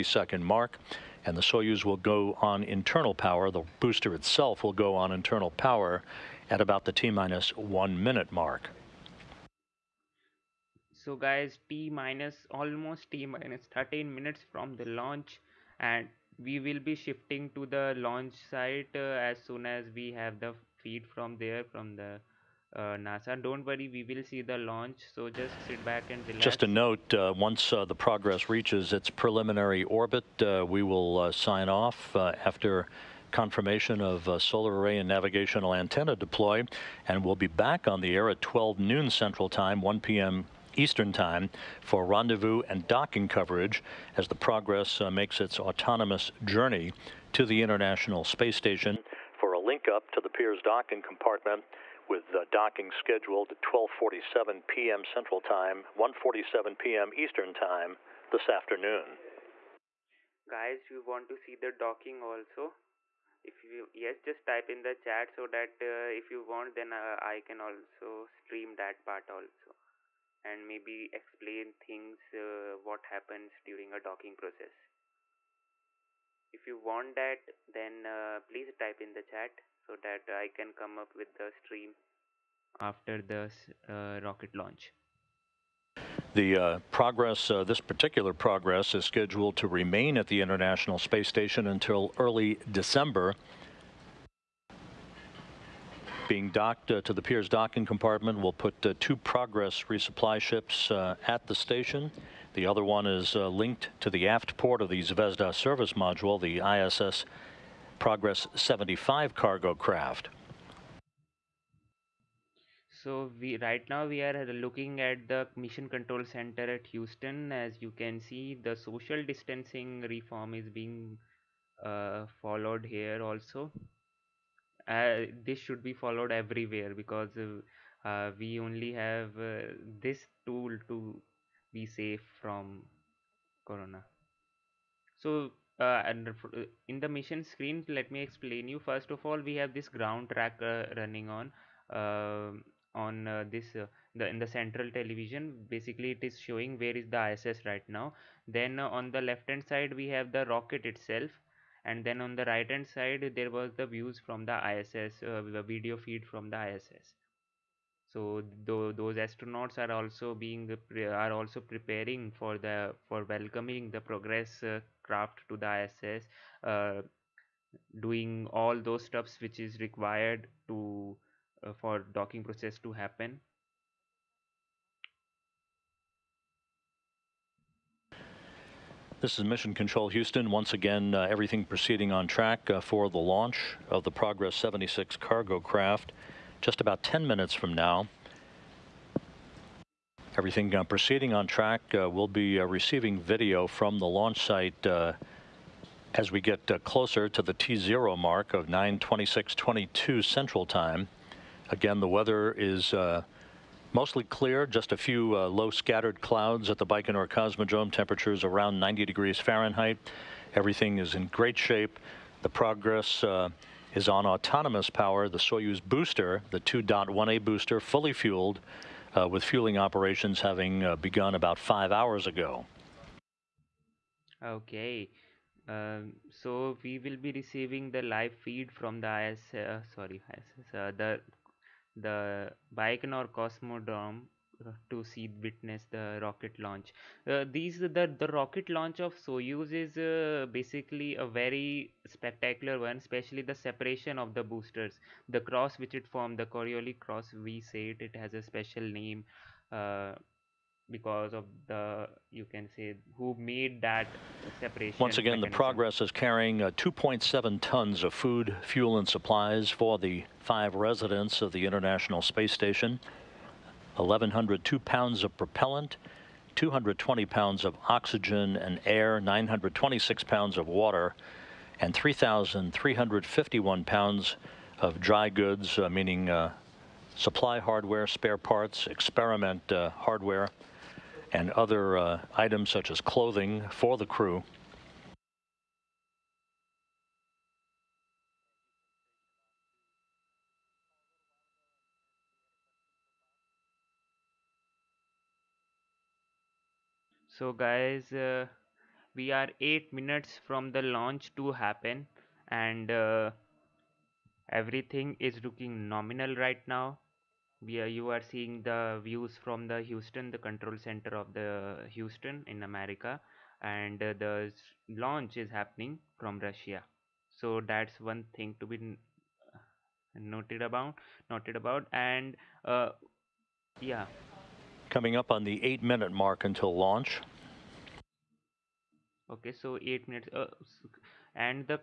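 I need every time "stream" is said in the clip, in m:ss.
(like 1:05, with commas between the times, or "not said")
1:08, 1:21.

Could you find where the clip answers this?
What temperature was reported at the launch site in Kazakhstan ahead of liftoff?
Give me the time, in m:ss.
3:28.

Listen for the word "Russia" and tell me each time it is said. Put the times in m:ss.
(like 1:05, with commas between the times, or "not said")
5:16.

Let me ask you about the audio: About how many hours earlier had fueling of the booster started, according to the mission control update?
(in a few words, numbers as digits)
5 hours.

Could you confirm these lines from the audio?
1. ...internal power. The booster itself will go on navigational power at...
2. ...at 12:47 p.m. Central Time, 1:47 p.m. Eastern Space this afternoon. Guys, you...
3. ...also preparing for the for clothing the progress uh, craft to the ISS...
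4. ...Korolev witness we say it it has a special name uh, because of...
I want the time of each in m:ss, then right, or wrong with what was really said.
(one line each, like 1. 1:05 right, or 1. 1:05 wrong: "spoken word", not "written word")
1. 0:02 wrong: "internal", not "navigational"
2. 0:53 wrong: "Time", not "Space"
3. 2:41 wrong: "welcoming", not "clothing"
4. 4:06 wrong: "cross", not "witness".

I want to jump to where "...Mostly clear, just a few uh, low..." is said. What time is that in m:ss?
3:23.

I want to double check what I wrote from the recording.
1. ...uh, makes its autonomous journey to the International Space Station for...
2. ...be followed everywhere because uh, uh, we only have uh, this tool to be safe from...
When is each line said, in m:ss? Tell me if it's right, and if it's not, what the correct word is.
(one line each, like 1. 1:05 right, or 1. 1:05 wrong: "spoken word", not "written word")
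1. 0:45 right
2. 2:05 right.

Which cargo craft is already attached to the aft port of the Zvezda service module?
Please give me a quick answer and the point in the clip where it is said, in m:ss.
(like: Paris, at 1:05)
Progress 75, at 1:46.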